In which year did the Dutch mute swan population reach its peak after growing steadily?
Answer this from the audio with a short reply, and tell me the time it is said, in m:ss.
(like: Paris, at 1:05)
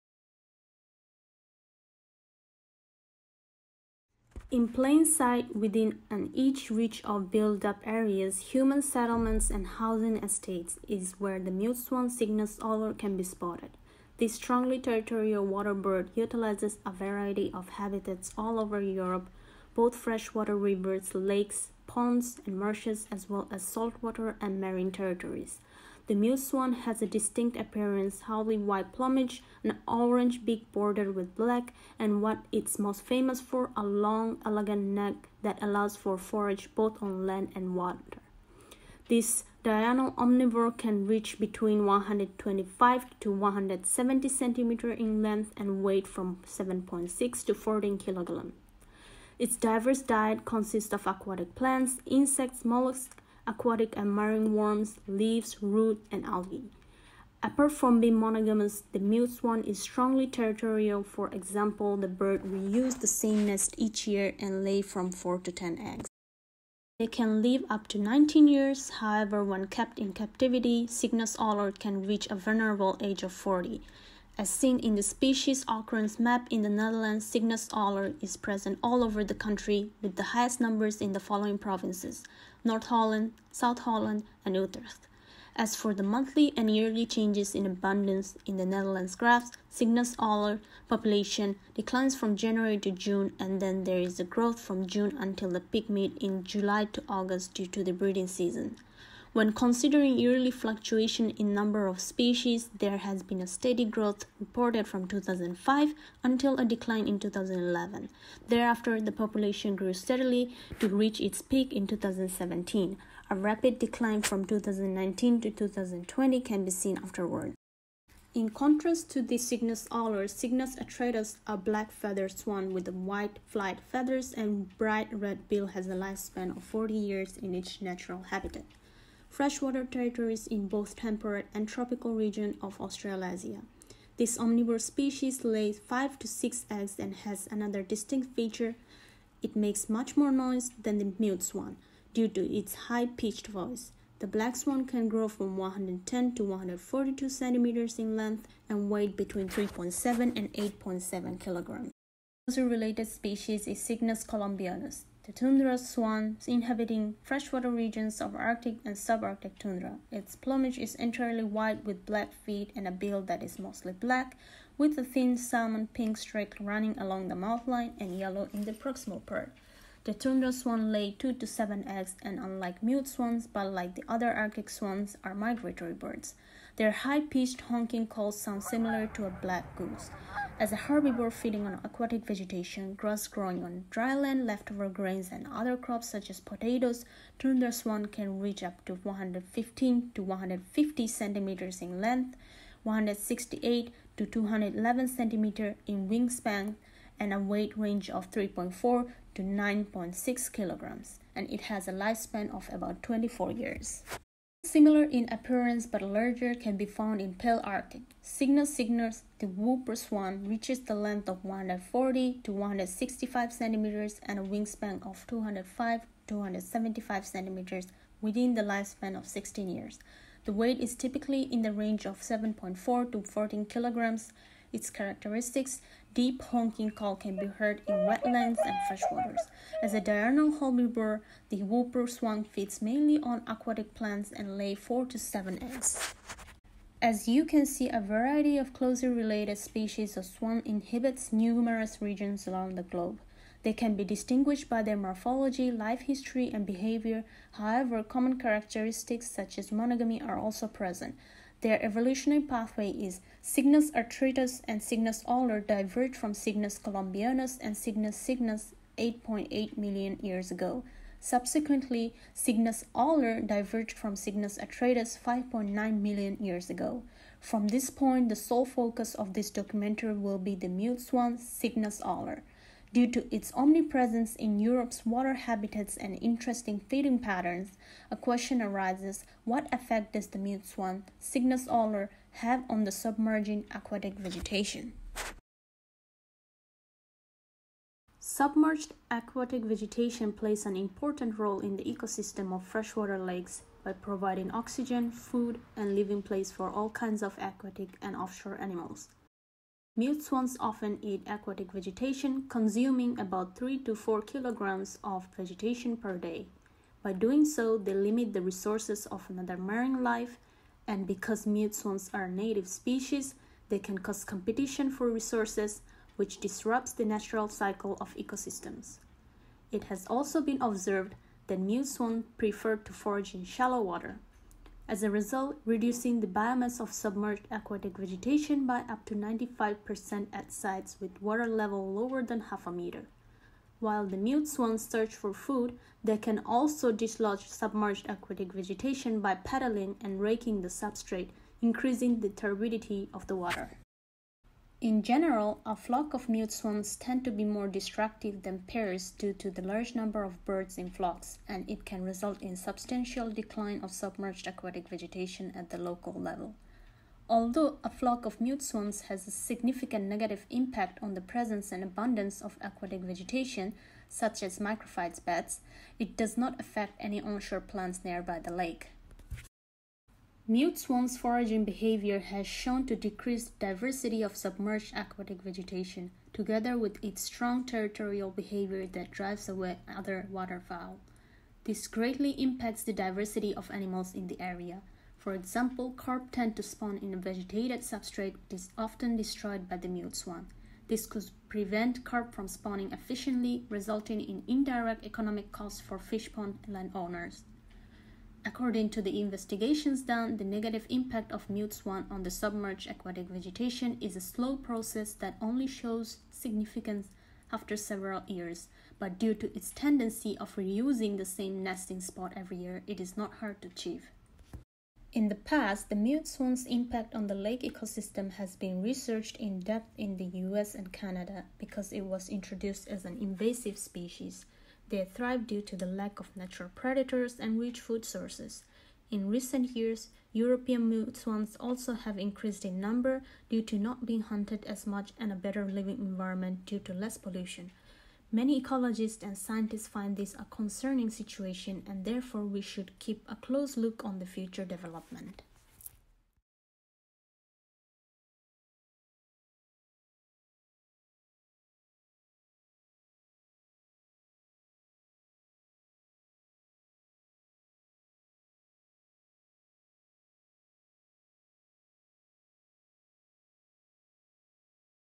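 2017, at 1:51.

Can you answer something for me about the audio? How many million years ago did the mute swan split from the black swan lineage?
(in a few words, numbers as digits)
5.9 million.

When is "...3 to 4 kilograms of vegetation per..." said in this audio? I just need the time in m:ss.
5:03.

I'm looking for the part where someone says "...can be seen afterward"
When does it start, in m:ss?
1:56.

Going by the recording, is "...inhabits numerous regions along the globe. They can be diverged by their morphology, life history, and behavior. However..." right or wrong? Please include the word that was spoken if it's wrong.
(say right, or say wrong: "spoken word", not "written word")
wrong: "distinguished", not "diverged".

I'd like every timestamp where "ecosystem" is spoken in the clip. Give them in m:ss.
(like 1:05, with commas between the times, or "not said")
4:51, 5:18, 6:57.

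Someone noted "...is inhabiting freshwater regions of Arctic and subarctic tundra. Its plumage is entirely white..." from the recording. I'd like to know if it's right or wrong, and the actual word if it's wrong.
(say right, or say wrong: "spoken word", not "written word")
right.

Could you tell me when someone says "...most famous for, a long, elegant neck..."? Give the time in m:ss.
0:32.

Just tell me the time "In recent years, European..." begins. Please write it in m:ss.
7:09.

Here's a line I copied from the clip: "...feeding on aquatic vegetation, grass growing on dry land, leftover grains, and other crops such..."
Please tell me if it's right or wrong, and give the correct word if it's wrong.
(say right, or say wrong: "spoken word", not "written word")
right.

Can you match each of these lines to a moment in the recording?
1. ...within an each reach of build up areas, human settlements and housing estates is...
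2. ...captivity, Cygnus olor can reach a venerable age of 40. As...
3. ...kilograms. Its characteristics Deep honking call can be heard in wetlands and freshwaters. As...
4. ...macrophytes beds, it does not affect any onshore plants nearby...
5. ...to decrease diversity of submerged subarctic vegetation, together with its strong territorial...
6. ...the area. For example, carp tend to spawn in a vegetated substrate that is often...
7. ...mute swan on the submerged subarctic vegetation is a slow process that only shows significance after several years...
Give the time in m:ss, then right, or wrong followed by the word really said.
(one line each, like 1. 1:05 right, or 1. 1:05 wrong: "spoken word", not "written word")
1. 0:05 right
2. 1:10 right
3. 3:43 right
4. 6:04 right
5. 6:12 wrong: "aquatic", not "subarctic"
6. 6:24 right
7. 6:41 wrong: "aquatic", not "subarctic".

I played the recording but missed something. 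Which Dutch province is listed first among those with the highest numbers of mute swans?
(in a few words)
North Holland.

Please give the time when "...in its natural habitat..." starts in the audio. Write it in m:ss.
2:07.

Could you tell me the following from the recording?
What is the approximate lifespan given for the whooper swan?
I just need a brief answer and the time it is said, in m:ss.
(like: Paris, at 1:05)
16 years, at 3:39.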